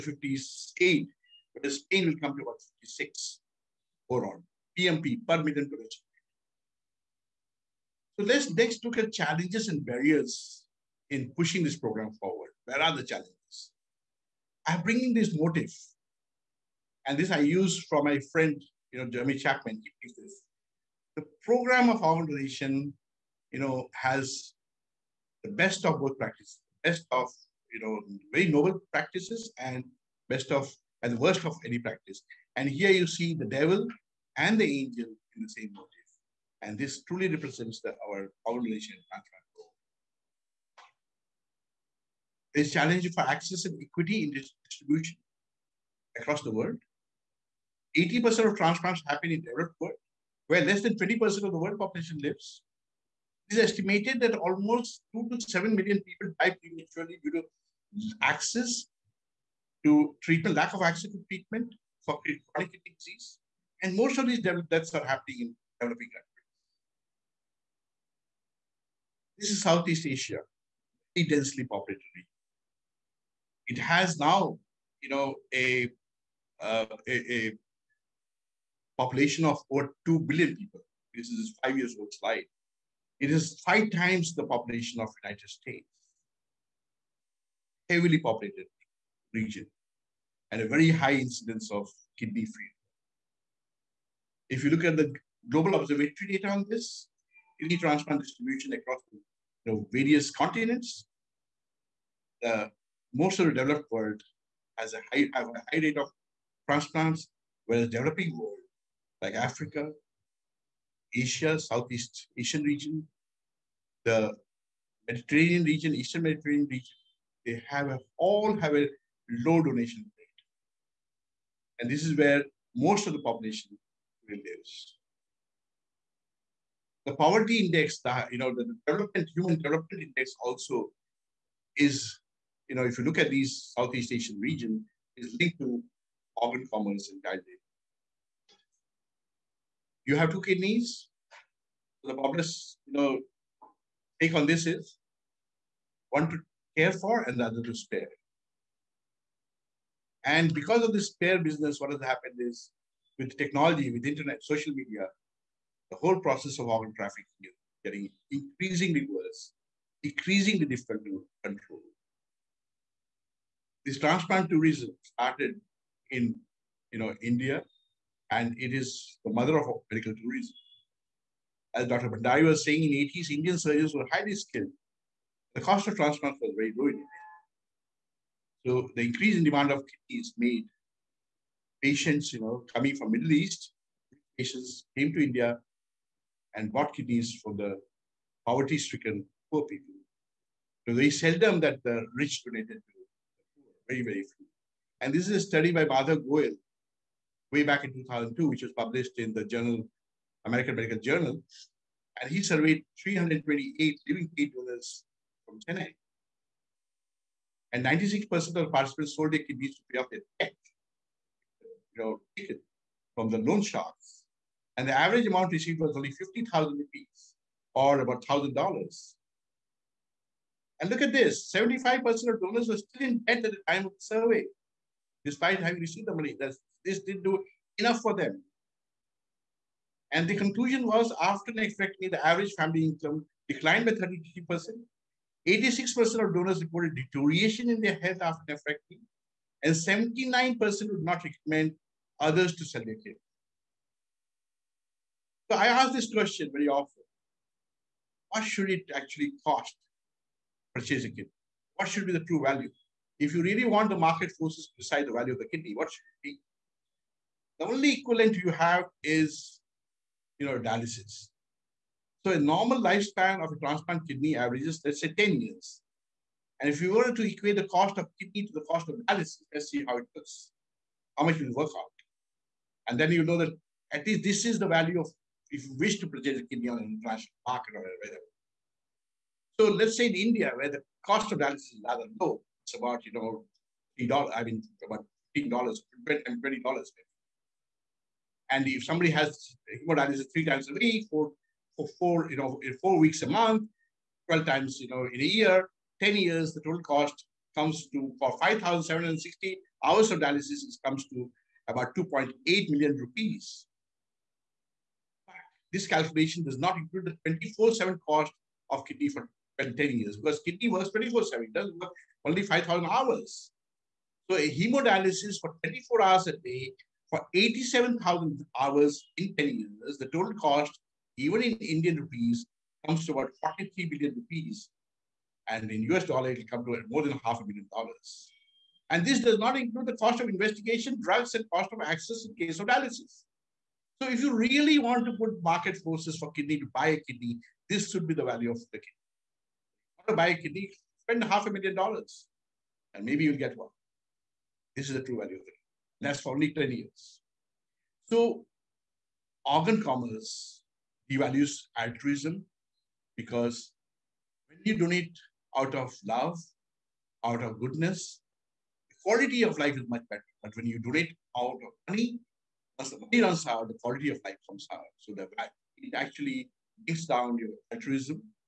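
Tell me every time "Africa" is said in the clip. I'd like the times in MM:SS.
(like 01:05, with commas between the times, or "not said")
01:49.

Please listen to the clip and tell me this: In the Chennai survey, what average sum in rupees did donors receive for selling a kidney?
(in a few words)
50,000 rupees.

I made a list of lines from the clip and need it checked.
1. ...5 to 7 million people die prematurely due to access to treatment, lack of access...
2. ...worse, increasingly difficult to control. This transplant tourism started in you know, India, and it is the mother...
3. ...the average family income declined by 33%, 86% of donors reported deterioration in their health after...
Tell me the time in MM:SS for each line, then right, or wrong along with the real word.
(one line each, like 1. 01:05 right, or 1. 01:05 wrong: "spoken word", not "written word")
1. 00:55 wrong: "2", not "5"
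2. 02:39 right
3. 03:52 right.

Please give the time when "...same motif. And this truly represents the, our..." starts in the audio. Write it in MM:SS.
00:35.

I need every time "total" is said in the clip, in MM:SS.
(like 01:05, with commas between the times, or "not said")
04:56, 05:20.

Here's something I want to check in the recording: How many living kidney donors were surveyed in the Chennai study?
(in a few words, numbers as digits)
328.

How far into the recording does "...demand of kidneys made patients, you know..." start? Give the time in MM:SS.
02:59.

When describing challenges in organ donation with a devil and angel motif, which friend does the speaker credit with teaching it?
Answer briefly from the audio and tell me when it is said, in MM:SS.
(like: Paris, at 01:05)
Jeremy Chapman, at 00:19.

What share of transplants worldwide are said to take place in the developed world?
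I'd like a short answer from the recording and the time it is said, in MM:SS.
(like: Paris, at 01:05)
80%, at 00:47.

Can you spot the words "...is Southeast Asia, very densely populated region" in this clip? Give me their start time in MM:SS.
01:09.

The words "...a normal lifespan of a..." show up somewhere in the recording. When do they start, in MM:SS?
04:22.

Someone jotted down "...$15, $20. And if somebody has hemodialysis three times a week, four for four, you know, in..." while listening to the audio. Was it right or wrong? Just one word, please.
right.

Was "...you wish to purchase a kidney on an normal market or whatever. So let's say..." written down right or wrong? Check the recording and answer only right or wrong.
wrong.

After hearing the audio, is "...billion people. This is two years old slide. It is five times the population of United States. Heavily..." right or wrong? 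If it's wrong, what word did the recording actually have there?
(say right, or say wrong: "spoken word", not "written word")
wrong: "five", not "two".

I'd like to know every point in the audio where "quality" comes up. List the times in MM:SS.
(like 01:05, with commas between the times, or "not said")
05:59, 06:03.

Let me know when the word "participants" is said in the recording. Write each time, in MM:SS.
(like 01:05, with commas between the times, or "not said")
03:28.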